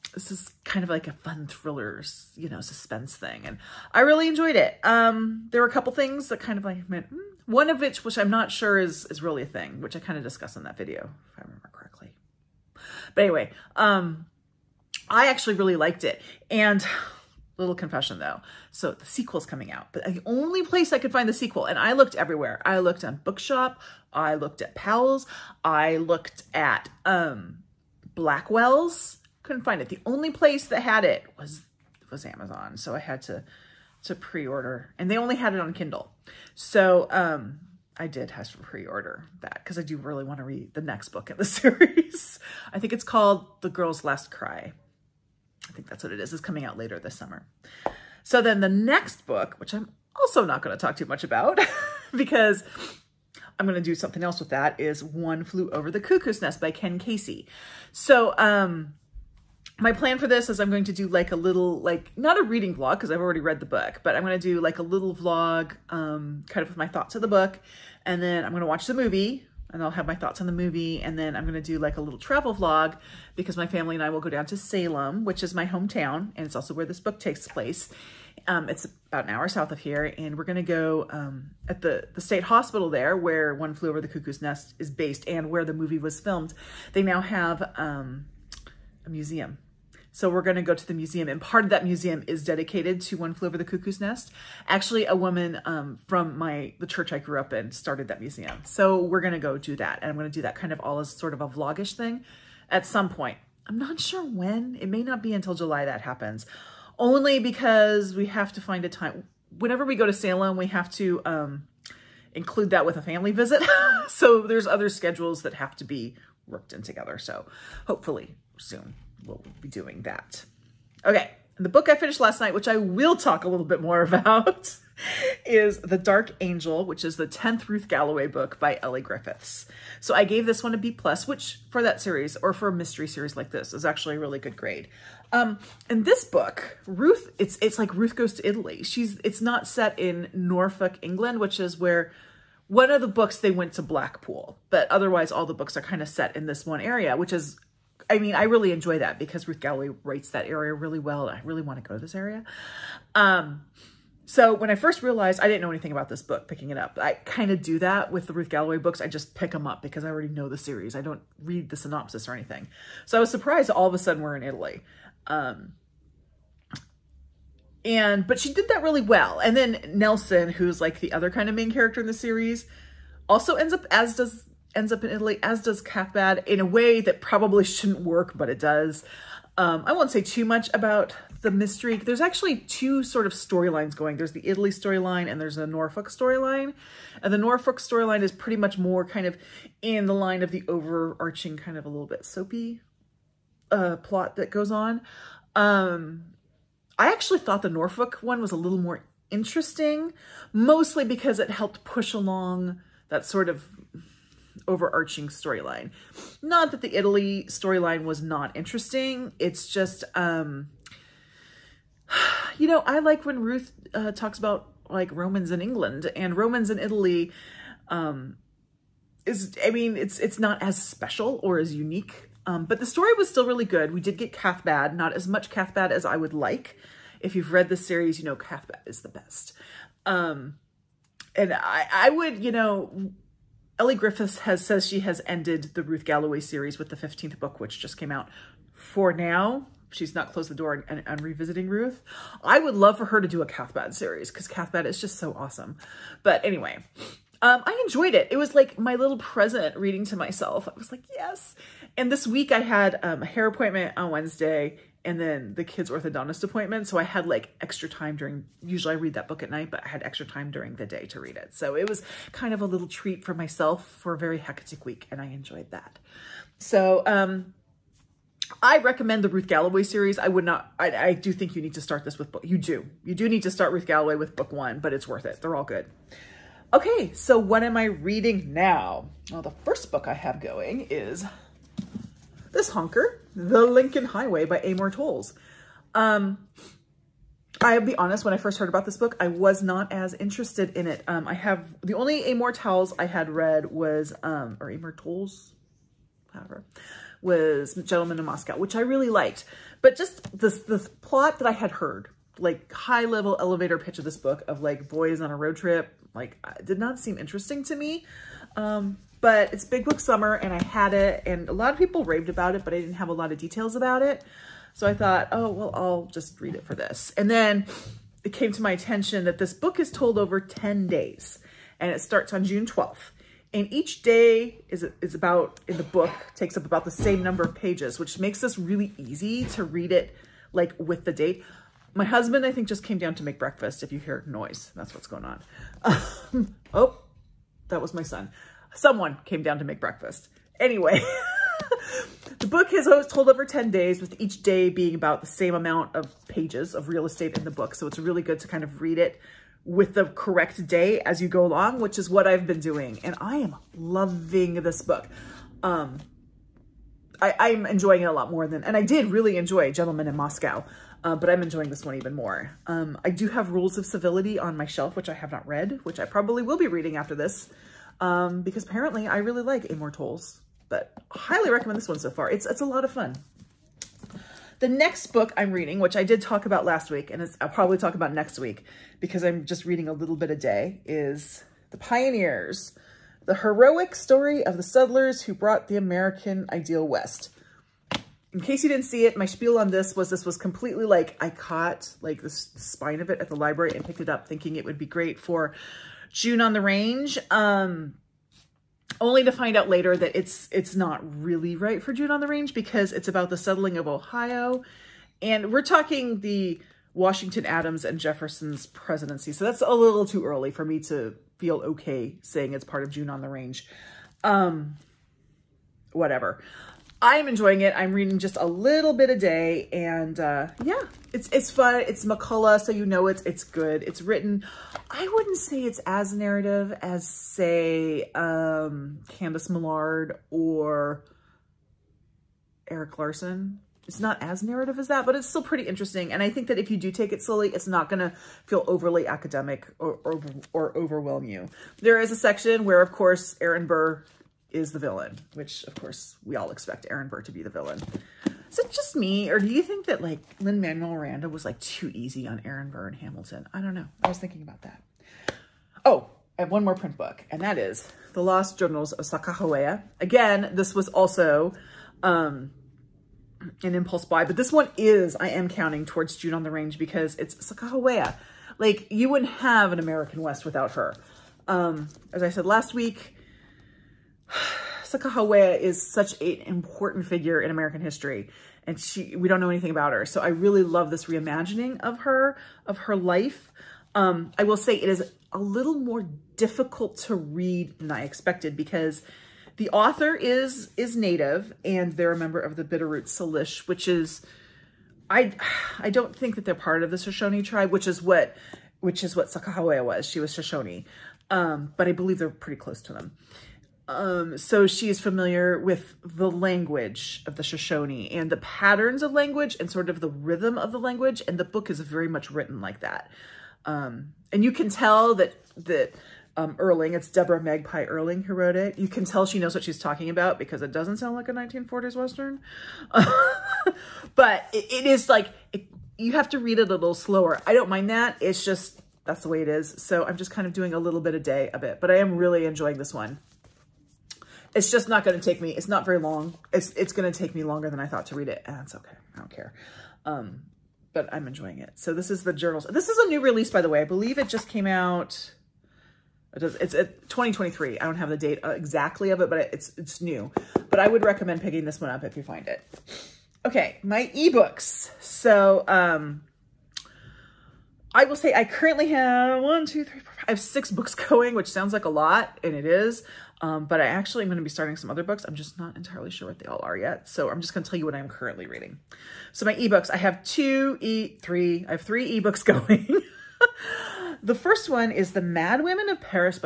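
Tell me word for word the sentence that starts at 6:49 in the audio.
So that's a little too early for me to feel okay saying it's part of June on the range.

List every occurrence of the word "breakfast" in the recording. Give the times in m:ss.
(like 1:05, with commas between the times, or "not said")
5:33, 5:39.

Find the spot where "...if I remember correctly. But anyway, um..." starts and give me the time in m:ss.
0:11.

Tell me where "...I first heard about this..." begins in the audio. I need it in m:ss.
4:48.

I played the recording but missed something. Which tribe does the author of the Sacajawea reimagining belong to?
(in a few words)
Bitterroot Salish.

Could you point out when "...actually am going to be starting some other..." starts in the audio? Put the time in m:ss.
9:23.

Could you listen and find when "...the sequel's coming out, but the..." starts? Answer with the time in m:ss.
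0:18.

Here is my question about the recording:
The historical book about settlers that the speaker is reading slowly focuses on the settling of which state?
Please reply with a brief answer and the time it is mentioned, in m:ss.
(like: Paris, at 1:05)
Ohio, at 6:43.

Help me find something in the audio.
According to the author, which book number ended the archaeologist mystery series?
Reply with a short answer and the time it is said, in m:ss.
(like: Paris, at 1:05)
15th, at 3:56.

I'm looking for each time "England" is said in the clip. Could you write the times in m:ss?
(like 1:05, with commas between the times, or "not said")
2:21, 3:35.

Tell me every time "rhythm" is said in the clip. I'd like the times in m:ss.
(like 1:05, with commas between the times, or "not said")
8:30.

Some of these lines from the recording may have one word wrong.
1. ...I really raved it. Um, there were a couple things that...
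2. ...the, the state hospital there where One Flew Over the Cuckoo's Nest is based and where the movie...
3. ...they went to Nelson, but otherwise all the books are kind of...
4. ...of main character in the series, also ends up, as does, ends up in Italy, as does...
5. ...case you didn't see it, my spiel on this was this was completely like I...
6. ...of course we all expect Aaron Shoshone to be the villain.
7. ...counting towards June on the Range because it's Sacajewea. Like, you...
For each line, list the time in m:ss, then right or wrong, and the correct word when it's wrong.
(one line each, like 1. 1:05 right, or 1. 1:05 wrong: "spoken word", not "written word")
1. 0:03 wrong: "enjoyed", not "raved"
2. 1:21 right
3. 2:23 wrong: "Blackpool", not "Nelson"
4. 2:51 right
5. 6:28 right
6. 7:25 wrong: "Burr", not "Shoshone"
7. 7:45 right.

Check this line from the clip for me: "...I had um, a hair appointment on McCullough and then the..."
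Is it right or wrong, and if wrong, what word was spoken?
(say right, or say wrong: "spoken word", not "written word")
wrong: "Wednesday", not "McCullough".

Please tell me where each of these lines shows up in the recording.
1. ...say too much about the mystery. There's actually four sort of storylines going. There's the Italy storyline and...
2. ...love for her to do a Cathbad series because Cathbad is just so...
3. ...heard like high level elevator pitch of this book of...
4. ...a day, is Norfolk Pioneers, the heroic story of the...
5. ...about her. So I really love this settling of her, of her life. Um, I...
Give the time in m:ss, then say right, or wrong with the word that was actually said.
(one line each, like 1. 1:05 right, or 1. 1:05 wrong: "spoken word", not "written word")
1. 3:00 wrong: "two", not "four"
2. 4:02 right
3. 5:01 right
4. 6:20 wrong: "The", not "Norfolk"
5. 7:59 wrong: "reimagining", not "settling".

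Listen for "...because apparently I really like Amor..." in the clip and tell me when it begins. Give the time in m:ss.
6:08.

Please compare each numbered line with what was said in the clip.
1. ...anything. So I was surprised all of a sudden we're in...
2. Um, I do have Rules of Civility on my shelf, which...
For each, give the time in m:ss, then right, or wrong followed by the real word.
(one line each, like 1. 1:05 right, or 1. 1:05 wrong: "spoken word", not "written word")
1. 2:42 right
2. 6:02 right.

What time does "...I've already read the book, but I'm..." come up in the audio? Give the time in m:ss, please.
1:03.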